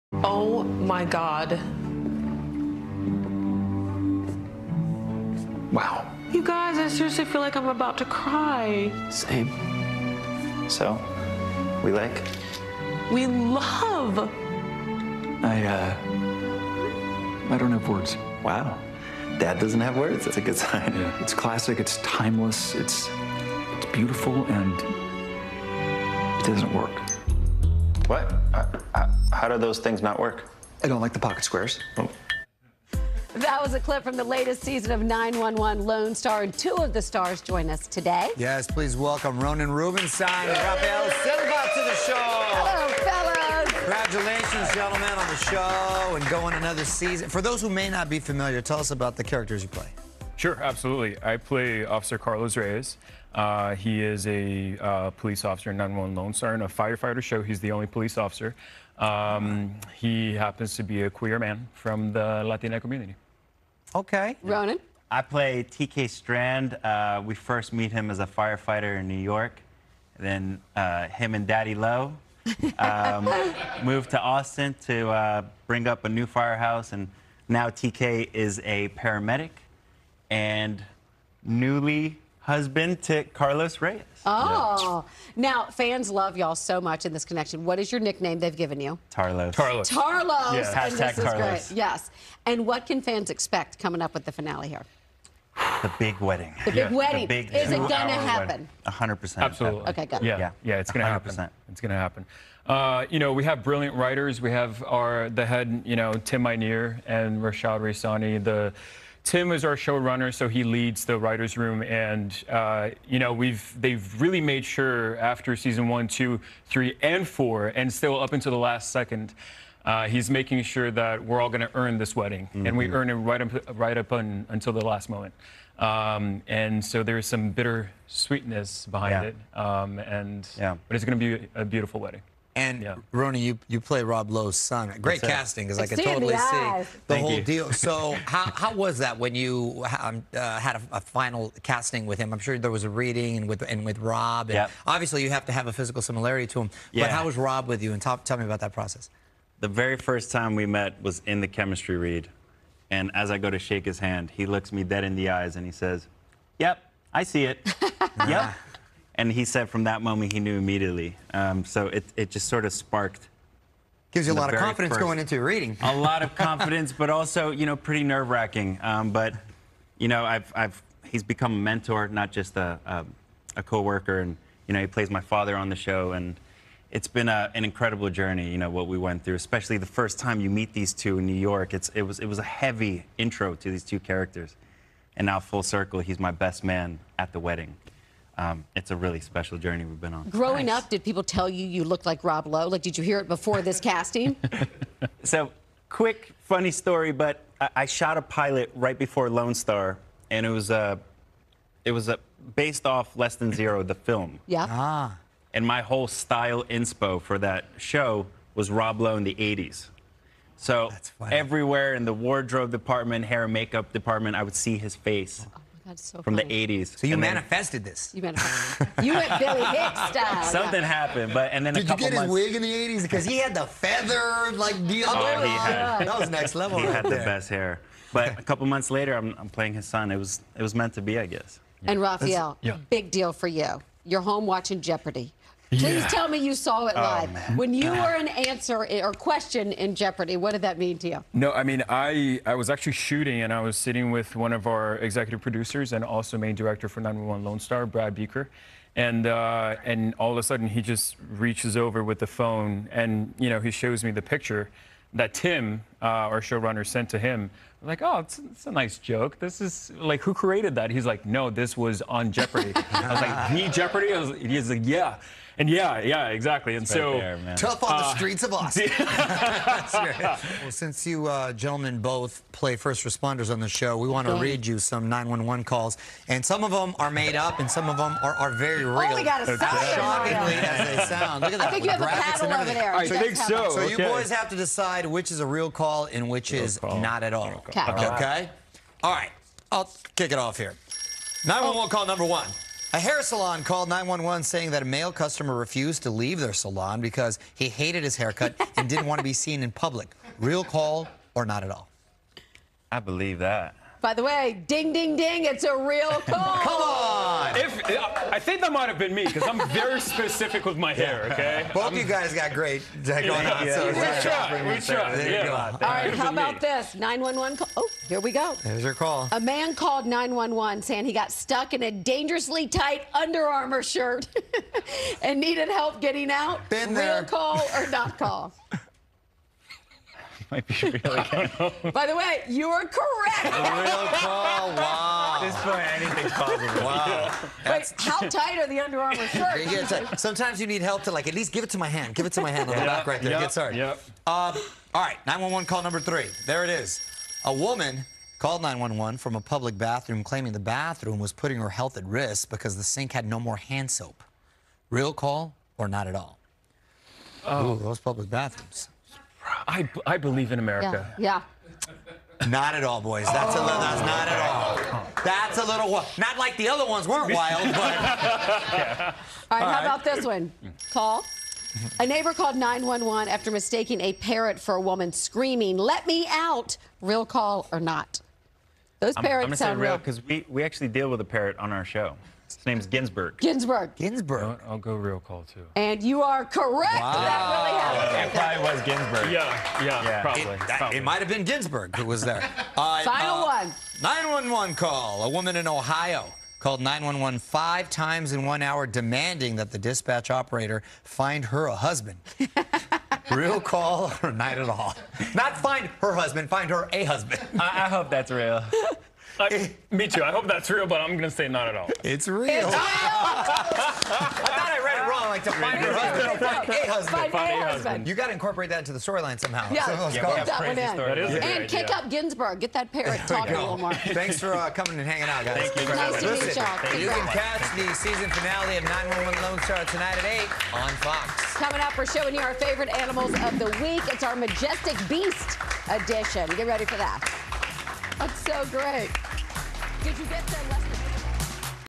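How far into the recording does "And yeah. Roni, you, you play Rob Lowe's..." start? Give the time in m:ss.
2:12.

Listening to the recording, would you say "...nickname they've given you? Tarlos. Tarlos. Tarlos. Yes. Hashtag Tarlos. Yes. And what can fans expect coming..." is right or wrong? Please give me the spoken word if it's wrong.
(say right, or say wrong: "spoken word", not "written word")
right.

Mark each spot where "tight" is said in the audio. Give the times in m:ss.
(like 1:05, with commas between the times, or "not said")
5:22, 5:38.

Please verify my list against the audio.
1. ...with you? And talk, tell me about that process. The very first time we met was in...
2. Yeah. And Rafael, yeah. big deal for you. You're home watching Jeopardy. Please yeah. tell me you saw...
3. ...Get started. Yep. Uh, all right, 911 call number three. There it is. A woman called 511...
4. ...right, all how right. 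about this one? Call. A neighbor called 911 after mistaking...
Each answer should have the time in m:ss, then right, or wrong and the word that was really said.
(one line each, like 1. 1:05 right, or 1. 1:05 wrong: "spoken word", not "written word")
1. 2:27 right
2. 3:51 right
3. 5:43 wrong: "911", not "511"
4. 6:09 right.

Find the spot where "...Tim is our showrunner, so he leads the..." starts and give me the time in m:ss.
1:49.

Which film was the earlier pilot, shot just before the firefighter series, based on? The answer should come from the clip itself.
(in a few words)
Less Than Zero.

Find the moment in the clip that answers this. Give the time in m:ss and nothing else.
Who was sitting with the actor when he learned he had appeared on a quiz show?
4:07.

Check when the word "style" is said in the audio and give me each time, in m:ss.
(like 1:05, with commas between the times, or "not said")
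3:26, 3:40.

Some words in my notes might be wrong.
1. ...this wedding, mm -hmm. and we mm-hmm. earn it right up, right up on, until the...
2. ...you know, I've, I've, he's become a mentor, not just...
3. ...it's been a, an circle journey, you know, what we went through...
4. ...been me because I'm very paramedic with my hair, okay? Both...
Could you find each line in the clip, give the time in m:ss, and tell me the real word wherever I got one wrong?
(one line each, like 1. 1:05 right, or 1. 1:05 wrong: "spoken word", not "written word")
1. 2:01 right
2. 2:49 right
3. 2:56 wrong: "incredible", not "circle"
4. 5:08 wrong: "specific", not "paramedic".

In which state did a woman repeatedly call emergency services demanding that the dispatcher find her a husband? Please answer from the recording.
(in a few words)
Ohio.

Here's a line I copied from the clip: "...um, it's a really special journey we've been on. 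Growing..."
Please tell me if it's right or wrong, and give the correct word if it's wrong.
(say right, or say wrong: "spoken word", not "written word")
right.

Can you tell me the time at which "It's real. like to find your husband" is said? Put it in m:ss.
6:52.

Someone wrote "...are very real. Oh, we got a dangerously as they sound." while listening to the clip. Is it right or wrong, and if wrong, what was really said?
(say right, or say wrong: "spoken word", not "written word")
wrong: "shockingly", not "dangerously".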